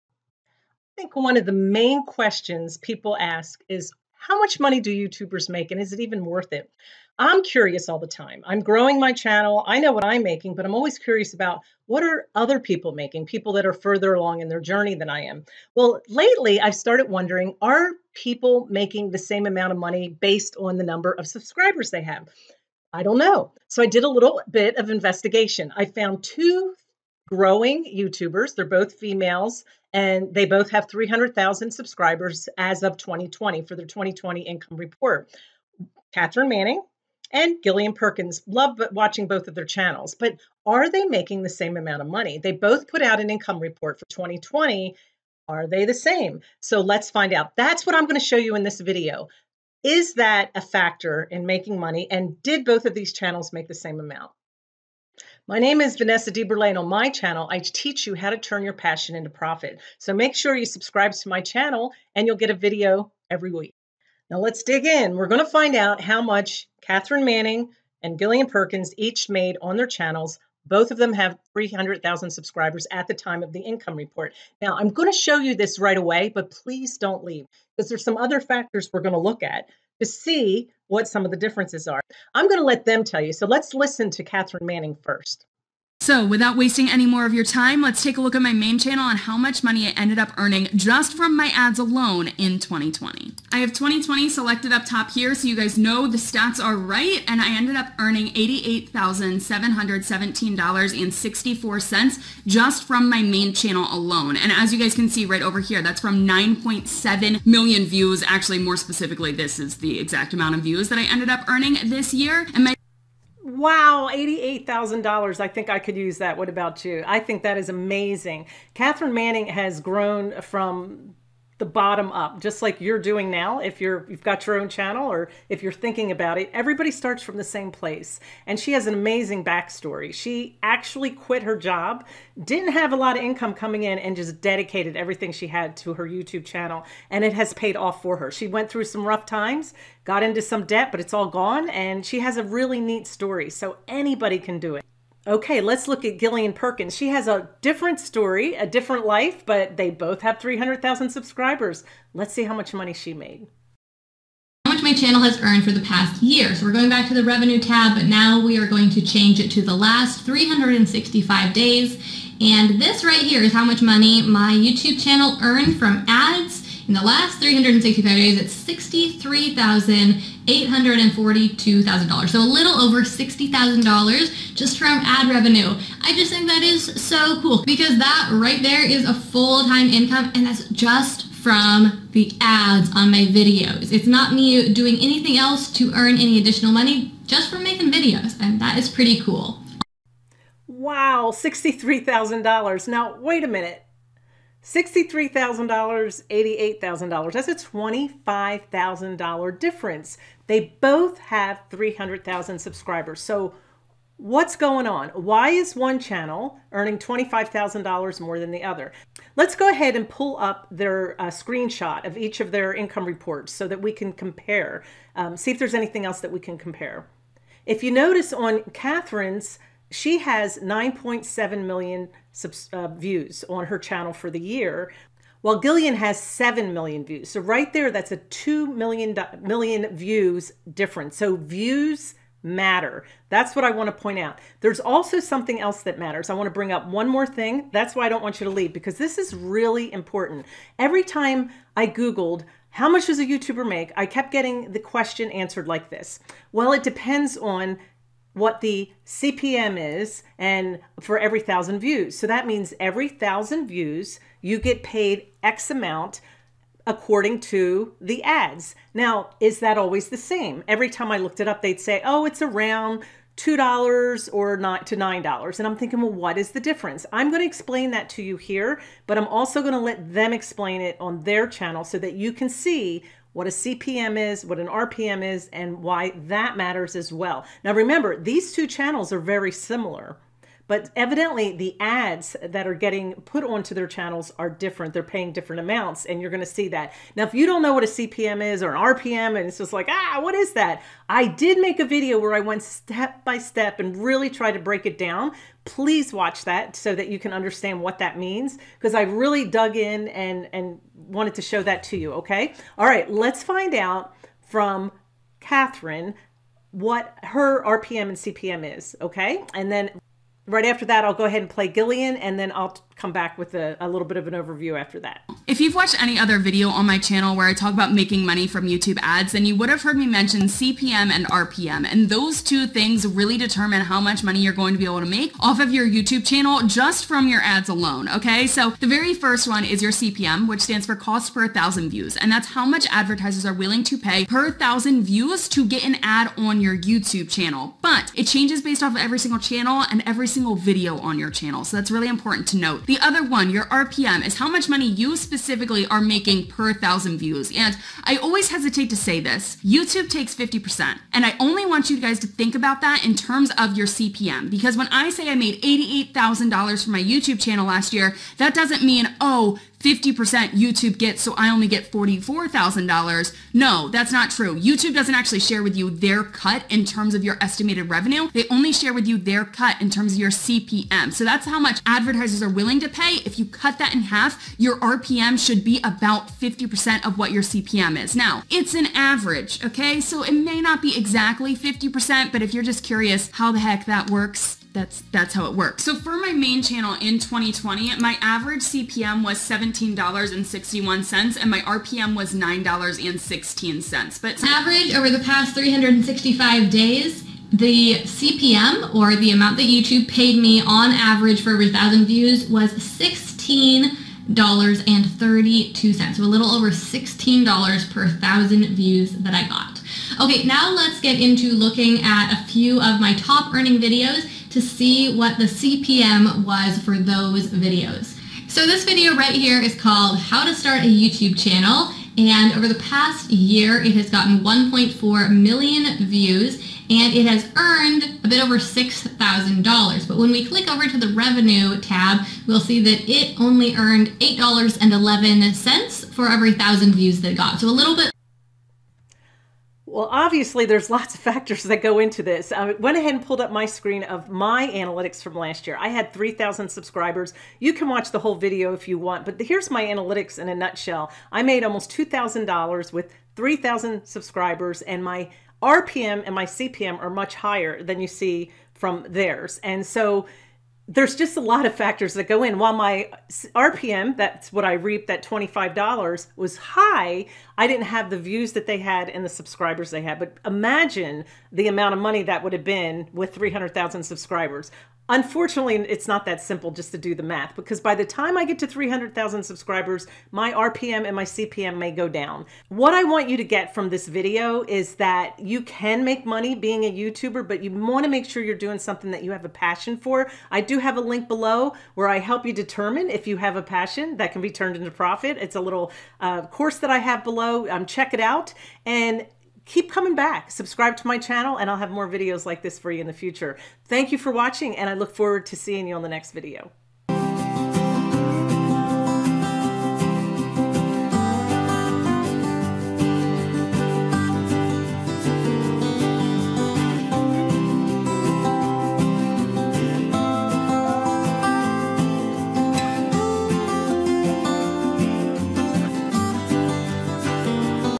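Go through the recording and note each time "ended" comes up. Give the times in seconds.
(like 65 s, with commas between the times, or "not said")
89 s, 97 s, 111 s.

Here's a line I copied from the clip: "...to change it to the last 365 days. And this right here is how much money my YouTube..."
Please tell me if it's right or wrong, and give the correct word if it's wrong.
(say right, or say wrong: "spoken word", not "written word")
right.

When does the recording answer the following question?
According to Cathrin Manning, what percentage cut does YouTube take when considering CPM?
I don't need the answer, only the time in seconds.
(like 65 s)
349 s.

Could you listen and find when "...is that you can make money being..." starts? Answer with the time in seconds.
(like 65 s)
484 s.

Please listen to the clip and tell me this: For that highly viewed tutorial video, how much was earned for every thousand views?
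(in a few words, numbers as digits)
$8.11.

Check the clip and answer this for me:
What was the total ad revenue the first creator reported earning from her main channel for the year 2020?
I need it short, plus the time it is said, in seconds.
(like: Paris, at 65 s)
$88,717.64, at 98 s.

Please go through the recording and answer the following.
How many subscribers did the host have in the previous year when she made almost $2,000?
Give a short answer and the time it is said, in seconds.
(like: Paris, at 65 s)
3,000, at 445 s.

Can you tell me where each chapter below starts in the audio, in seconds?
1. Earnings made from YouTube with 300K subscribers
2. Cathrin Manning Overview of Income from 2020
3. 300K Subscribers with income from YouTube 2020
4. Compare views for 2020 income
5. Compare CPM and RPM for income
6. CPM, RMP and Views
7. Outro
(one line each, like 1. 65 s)
1. 78 s
2. 120 s
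3. 151 s
4. 193 s
5. 249 s
6. 441 s
7. 499 s.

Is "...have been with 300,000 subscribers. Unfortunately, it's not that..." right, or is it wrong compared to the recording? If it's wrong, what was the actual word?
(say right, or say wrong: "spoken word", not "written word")
right.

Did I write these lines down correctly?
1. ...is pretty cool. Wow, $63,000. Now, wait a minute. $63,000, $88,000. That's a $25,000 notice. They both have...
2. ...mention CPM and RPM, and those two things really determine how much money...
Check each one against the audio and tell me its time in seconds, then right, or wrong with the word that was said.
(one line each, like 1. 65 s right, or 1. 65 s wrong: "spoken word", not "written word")
1. 188 s wrong: "difference", not "notice"
2. 320 s right.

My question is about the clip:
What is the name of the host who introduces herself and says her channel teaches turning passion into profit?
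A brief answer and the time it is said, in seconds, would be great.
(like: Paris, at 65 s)
Vanessa DeBurlet, at 55 s.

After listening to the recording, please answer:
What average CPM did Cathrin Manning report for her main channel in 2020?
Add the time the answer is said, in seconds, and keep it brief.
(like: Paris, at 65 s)
$17.61, at 389 s.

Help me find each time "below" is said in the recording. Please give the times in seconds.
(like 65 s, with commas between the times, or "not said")
491 s, 497 s.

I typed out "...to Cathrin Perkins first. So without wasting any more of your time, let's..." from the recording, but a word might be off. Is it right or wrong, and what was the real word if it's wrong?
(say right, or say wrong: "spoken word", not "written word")
wrong: "Manning", not "Perkins".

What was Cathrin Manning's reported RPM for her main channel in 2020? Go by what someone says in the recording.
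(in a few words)
$9.16.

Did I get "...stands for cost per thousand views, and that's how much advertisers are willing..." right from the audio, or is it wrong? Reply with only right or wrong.
right.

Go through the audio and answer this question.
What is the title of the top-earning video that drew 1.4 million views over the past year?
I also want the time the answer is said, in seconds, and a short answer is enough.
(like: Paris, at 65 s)
How to Start a YouTube Channel, at 420 s.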